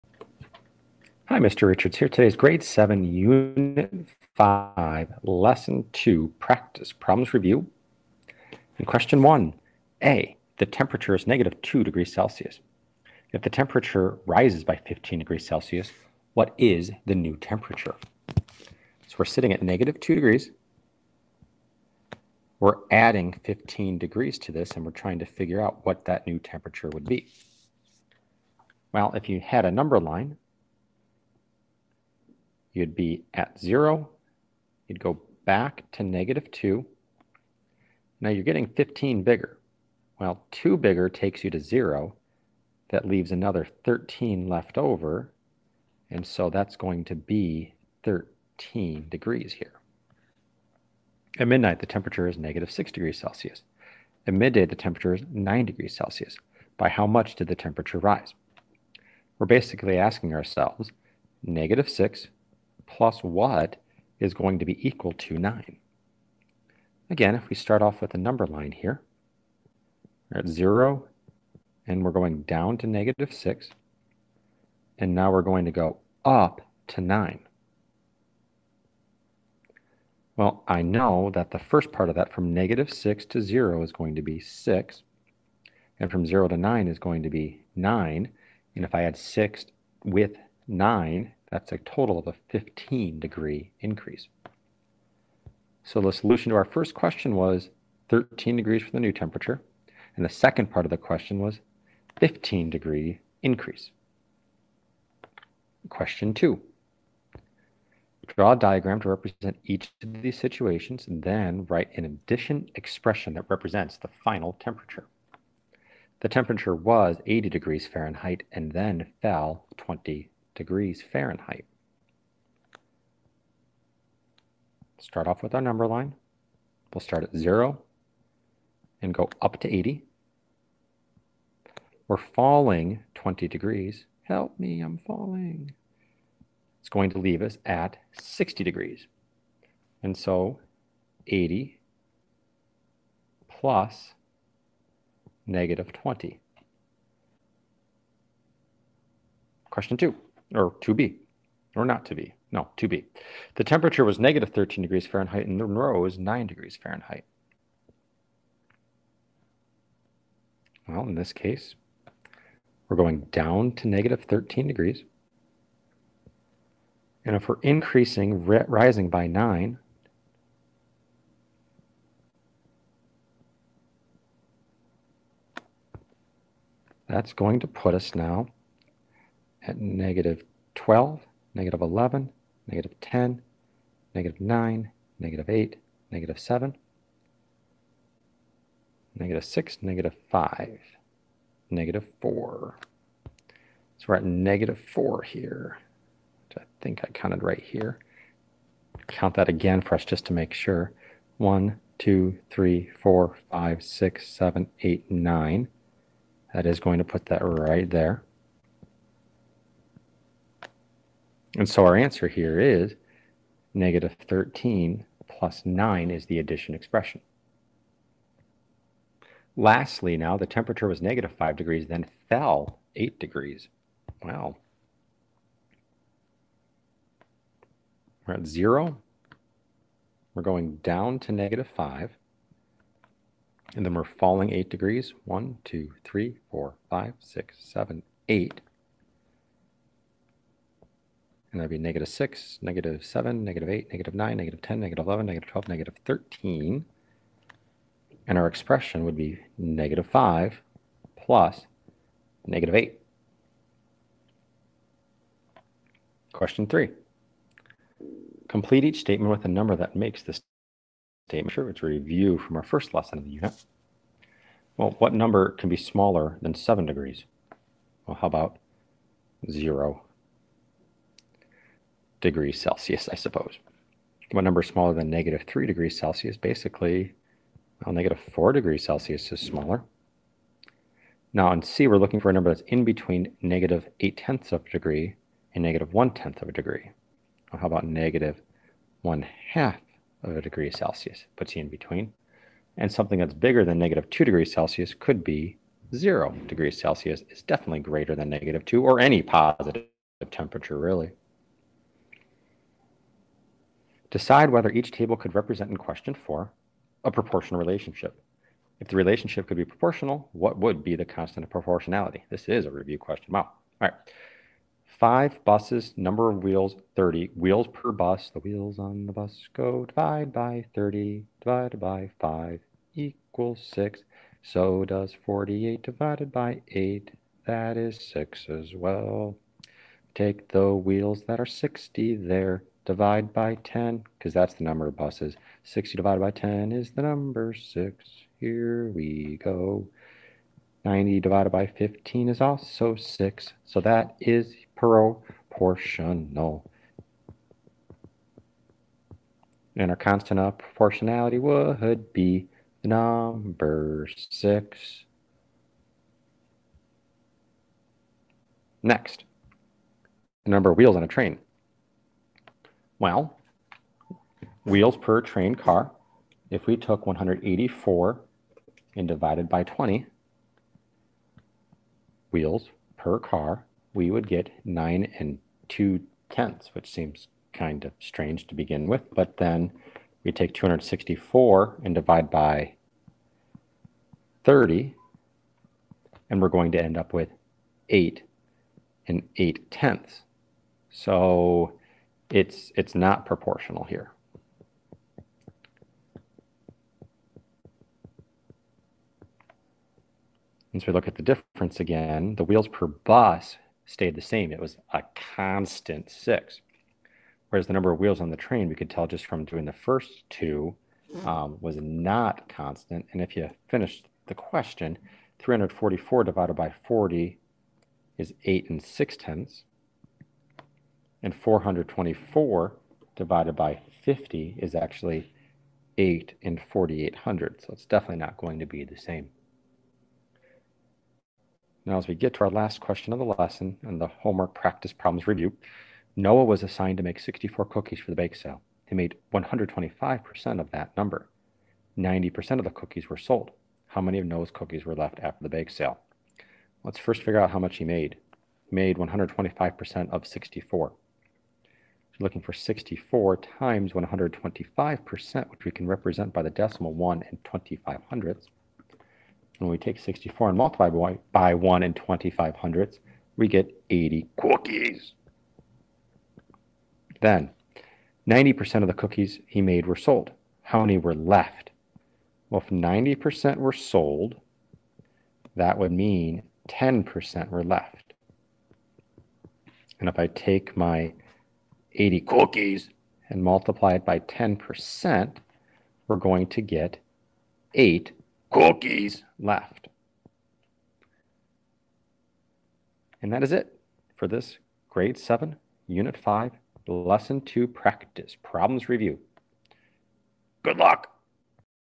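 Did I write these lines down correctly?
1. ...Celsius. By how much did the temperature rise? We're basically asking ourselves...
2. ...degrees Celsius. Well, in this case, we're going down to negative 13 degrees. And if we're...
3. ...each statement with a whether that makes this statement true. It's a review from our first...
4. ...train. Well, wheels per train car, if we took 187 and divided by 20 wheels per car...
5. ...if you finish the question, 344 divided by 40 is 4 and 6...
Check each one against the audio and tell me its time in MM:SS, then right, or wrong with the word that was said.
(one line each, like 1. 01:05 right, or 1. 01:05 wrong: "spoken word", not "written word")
1. 00:55 right
2. 02:36 wrong: "Fahrenheit", not "Celsius"
3. 04:18 wrong: "number", not "whether"
4. 06:01 wrong: "184", not "187"
5. 06:53 wrong: "8", not "4".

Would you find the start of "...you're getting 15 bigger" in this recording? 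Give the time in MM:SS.
00:38.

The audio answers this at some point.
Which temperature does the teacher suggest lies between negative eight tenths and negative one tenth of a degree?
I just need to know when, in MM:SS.
04:47.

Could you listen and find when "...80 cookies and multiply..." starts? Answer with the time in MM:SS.
08:01.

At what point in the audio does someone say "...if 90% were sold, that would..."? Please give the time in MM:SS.
07:52.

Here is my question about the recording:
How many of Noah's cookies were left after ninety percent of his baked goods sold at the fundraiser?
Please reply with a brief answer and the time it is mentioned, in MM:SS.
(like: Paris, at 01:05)
8, at 08:07.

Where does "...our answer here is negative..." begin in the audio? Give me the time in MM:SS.
03:31.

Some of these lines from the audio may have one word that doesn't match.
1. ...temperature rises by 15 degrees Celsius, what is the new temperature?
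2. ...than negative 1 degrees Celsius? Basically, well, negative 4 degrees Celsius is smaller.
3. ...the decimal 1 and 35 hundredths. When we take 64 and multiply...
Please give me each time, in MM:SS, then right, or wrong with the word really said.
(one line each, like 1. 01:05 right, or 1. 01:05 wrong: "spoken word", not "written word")
1. 00:13 right
2. 04:34 wrong: "3", not "1"
3. 07:36 wrong: "25", not "35".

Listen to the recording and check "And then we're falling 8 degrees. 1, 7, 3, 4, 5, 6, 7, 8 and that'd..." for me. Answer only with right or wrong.
wrong.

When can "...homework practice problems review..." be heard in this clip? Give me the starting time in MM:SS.
07:14.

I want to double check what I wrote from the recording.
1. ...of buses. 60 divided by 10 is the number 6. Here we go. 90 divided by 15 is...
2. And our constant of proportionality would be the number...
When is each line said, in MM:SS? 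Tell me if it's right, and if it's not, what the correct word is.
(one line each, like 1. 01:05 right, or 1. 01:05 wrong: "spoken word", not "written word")
1. 05:34 right
2. 05:49 right.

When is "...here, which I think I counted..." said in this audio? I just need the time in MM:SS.
03:15.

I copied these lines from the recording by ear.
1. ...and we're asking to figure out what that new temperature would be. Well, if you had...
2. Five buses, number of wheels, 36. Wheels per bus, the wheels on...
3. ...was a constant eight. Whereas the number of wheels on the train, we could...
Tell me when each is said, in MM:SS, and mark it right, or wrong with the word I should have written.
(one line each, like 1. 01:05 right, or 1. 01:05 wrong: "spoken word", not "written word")
1. 00:24 wrong: "trying", not "asking"
2. 05:14 wrong: "30", not "36"
3. 06:44 wrong: "six", not "eight".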